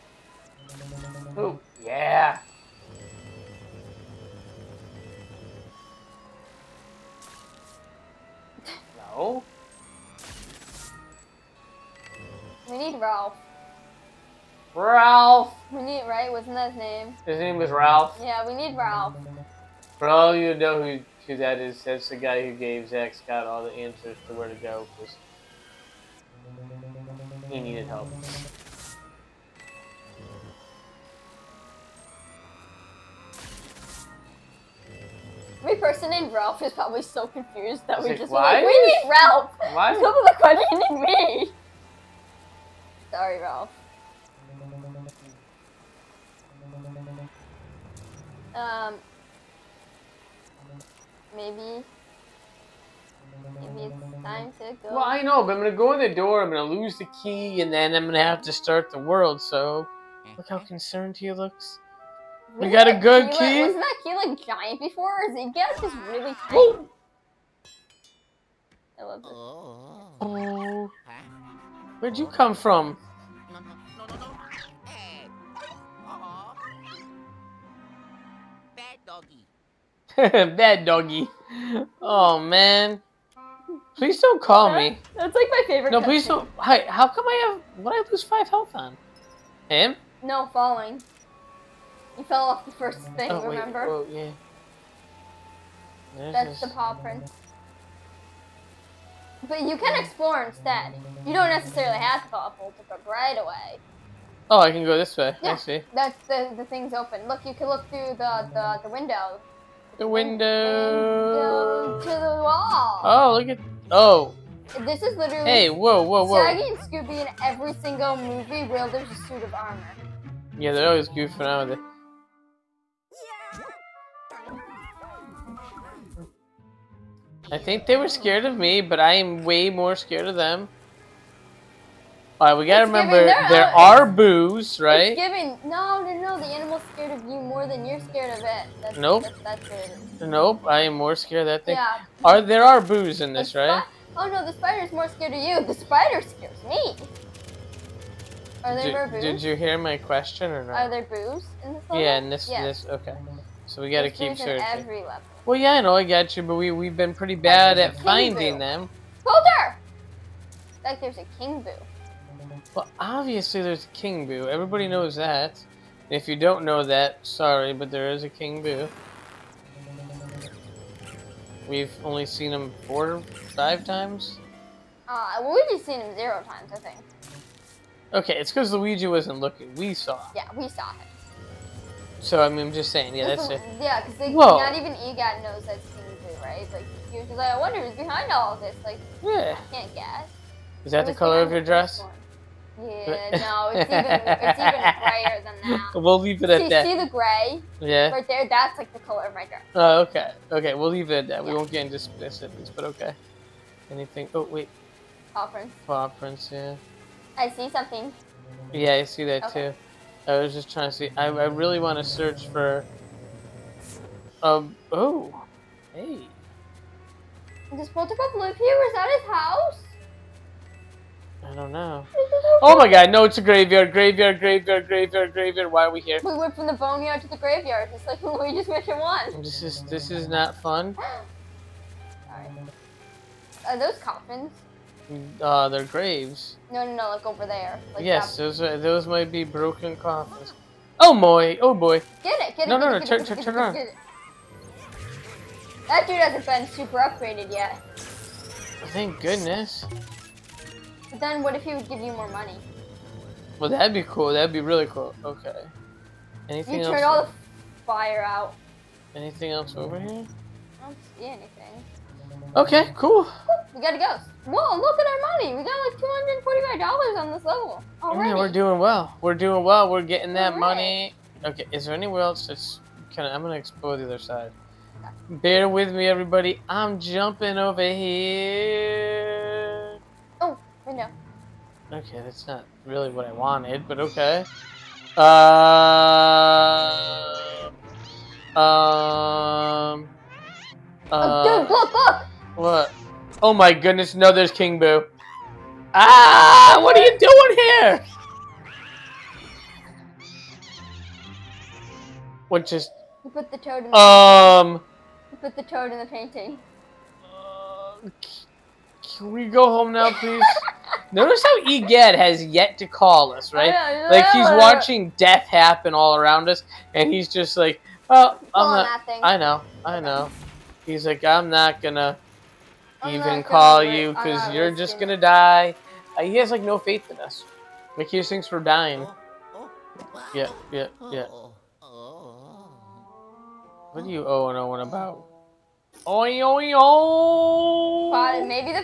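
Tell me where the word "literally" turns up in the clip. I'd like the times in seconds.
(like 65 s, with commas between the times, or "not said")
115 s.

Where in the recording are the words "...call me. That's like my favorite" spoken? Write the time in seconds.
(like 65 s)
84 s.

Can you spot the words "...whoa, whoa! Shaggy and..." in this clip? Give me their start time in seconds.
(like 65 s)
116 s.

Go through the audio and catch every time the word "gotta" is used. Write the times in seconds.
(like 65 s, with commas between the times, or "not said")
132 s, 153 s, 263 s.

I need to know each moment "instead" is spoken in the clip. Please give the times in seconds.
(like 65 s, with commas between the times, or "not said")
100 s.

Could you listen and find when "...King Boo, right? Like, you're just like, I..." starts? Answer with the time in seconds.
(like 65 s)
185 s.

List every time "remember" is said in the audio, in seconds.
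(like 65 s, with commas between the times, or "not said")
93 s, 132 s.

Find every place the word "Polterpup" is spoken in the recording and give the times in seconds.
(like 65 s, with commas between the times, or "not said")
102 s.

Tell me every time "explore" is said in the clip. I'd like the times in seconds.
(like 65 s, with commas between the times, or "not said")
100 s, 273 s.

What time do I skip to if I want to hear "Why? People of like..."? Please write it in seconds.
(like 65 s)
39 s.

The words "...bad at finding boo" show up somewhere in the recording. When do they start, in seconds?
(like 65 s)
157 s.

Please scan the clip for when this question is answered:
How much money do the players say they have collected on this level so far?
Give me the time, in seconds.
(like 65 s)
266 s.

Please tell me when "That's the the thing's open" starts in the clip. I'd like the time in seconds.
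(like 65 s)
105 s.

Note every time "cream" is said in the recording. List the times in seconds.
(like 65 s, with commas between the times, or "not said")
not said.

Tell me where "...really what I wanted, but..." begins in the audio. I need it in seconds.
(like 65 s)
282 s.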